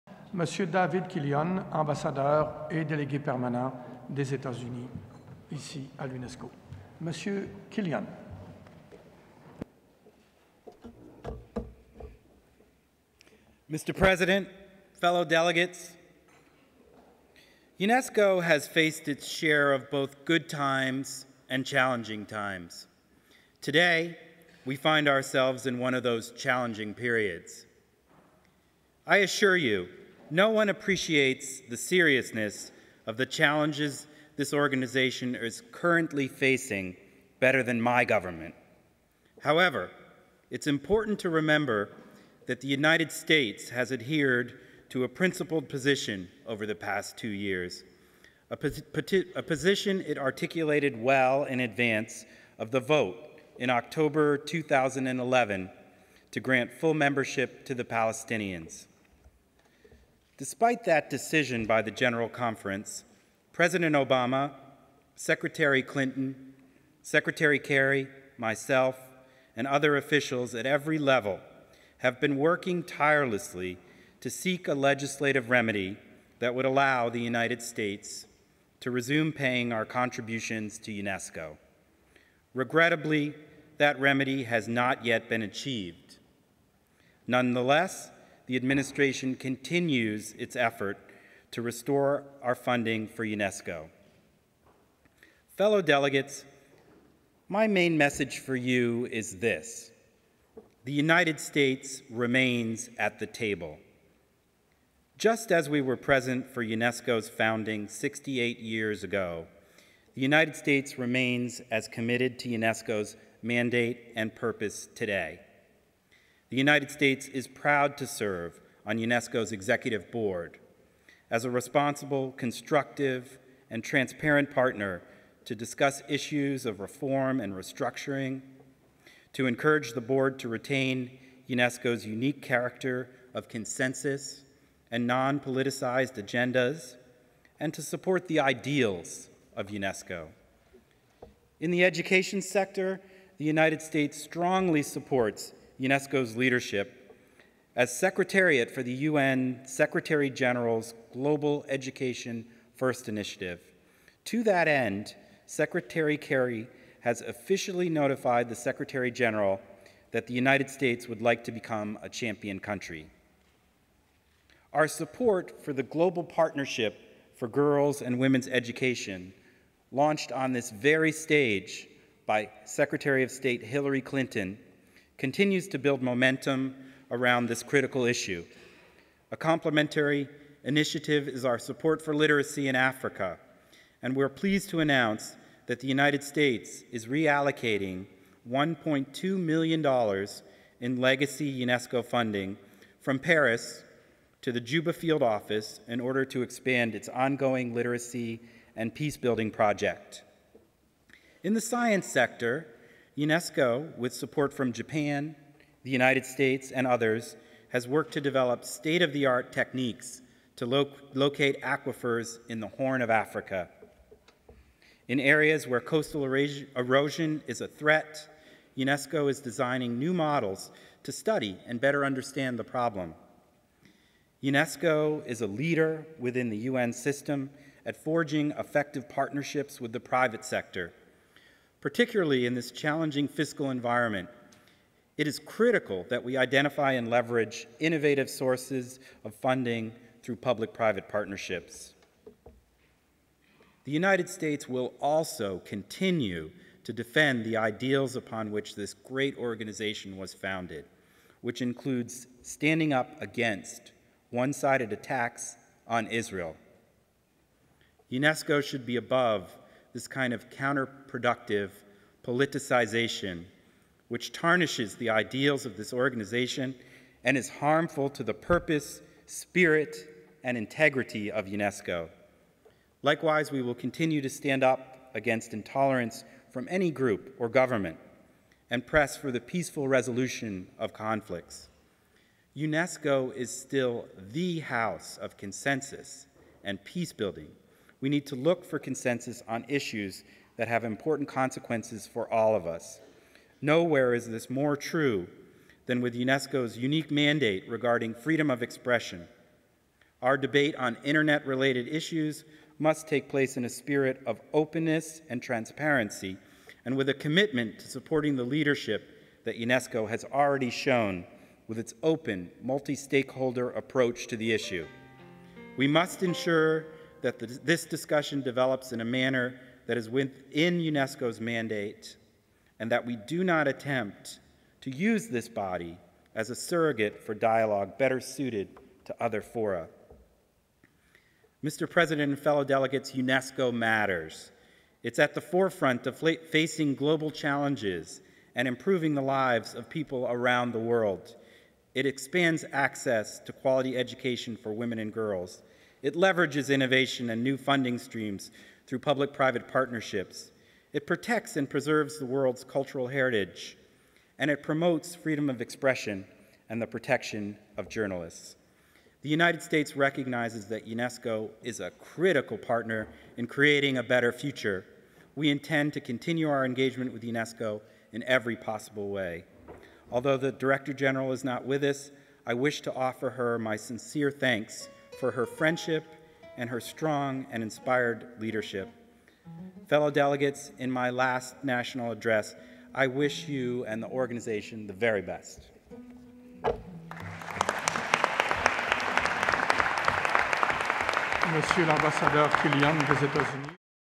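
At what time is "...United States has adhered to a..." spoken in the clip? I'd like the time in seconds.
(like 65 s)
42 s.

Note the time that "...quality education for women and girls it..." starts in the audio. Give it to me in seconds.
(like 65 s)
343 s.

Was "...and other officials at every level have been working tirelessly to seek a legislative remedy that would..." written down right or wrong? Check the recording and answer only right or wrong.
right.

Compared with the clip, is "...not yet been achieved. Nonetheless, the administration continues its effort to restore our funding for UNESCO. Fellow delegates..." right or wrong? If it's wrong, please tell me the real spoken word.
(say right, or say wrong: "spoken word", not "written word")
right.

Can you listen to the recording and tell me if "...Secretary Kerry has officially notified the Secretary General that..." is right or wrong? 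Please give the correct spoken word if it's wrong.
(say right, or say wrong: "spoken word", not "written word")
right.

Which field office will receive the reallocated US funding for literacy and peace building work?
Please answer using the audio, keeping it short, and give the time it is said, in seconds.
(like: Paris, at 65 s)
Juba, at 194 s.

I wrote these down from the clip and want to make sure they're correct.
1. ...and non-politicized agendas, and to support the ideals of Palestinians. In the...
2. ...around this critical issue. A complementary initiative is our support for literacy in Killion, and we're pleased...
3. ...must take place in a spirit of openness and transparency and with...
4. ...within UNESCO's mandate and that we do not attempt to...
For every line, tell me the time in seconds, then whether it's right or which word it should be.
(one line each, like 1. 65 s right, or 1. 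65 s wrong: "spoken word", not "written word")
1. 134 s wrong: "UNESCO", not "Palestinians"
2. 177 s wrong: "Africa", not "Killion"
3. 302 s right
4. 320 s right.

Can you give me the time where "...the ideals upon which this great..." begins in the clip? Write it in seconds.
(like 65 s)
247 s.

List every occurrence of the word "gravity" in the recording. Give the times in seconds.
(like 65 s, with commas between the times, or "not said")
not said.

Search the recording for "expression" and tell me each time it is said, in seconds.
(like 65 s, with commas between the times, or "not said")
298 s, 355 s.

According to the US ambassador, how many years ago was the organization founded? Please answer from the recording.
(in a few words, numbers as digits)
68.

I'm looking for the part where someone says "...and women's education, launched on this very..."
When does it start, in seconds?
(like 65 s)
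168 s.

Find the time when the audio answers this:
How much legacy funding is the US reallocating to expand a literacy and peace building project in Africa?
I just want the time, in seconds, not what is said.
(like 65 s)
188 s.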